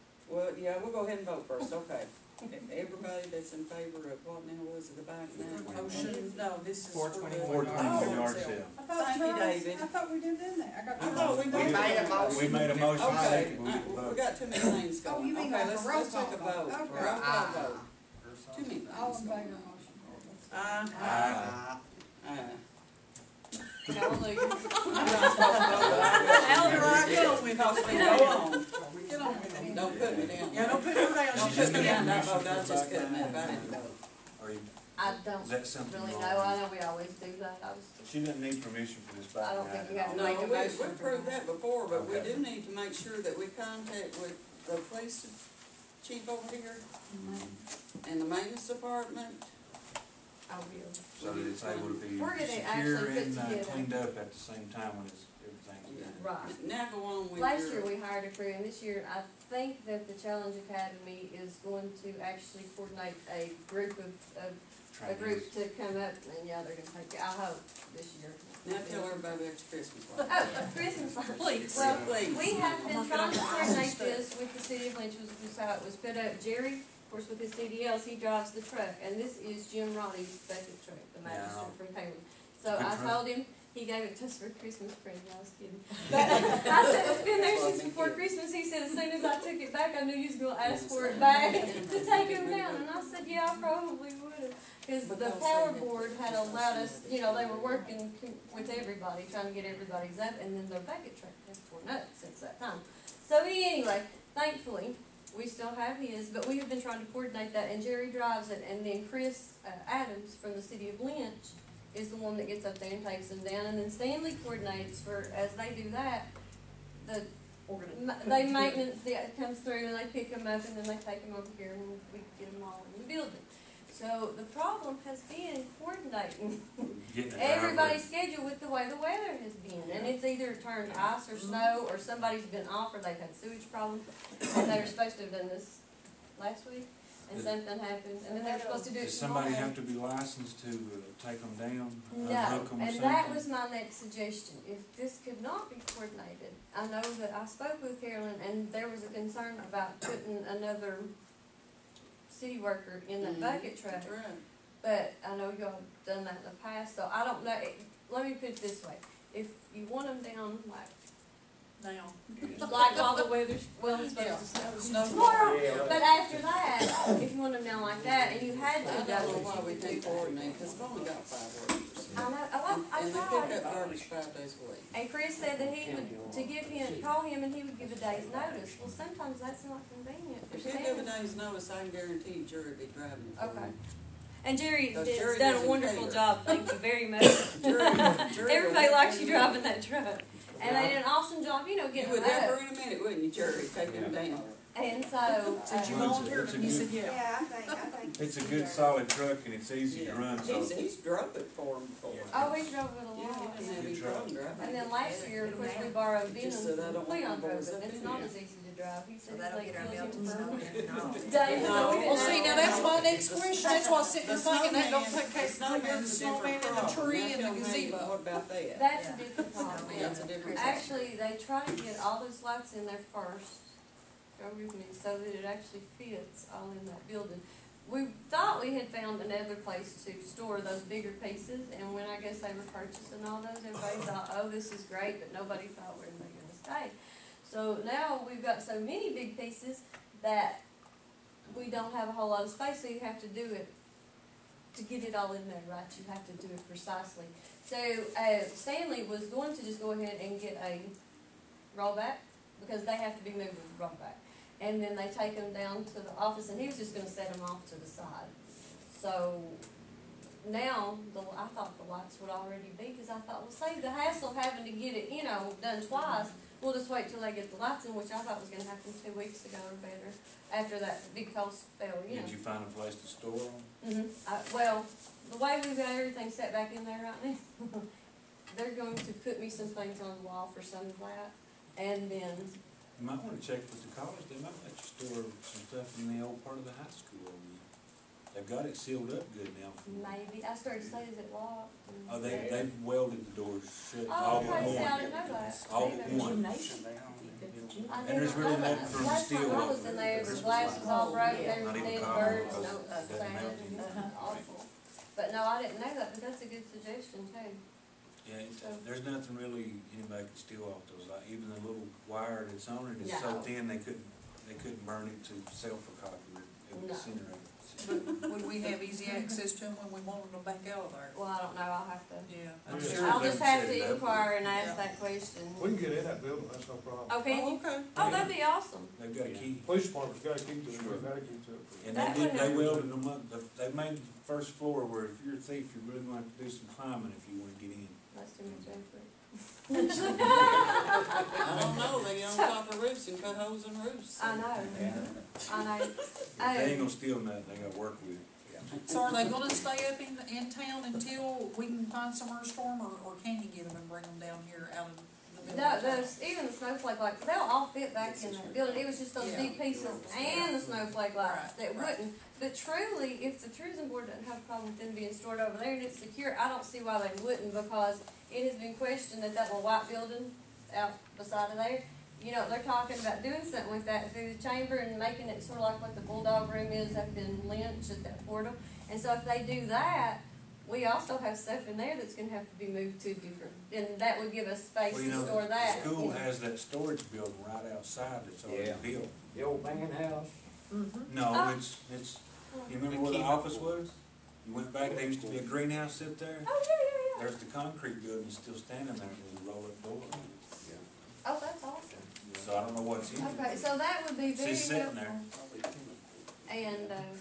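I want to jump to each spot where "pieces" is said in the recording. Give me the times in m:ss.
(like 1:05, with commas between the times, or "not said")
3:51, 3:59, 5:59.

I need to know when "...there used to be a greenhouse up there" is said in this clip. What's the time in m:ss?
6:34.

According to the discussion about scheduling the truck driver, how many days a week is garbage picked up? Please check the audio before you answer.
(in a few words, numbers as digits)
5.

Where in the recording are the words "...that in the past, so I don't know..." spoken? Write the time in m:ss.
2:36.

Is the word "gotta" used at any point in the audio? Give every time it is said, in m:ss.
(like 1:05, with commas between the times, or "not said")
5:30, 5:47.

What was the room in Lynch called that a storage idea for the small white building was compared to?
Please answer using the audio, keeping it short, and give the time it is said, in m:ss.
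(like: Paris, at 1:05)
the bulldog room, at 6:16.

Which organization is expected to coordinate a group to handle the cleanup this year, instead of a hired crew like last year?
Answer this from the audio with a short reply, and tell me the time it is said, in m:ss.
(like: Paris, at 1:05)
Challenge Academy, at 1:00.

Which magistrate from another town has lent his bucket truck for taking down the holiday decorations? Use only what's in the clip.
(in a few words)
Jim Roddy.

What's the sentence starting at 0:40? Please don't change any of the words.
we have proved that before, but we do need to make sure that we contact with the police chief over here mm-hmm.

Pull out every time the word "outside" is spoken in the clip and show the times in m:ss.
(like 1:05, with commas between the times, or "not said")
6:27.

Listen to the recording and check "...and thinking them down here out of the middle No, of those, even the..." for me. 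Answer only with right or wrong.
wrong.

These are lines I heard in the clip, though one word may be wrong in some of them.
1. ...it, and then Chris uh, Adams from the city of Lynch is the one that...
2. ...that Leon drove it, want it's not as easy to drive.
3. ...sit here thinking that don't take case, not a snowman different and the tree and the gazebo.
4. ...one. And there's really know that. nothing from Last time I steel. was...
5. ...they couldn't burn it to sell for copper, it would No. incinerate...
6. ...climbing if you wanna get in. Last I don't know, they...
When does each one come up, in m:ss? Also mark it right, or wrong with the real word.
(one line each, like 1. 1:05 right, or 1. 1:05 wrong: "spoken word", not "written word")
1. 1:48 right
2. 3:26 right
3. 3:34 right
4. 4:56 right
5. 5:14 right
6. 5:36 right.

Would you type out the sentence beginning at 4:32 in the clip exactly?
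Did you find a place to store them?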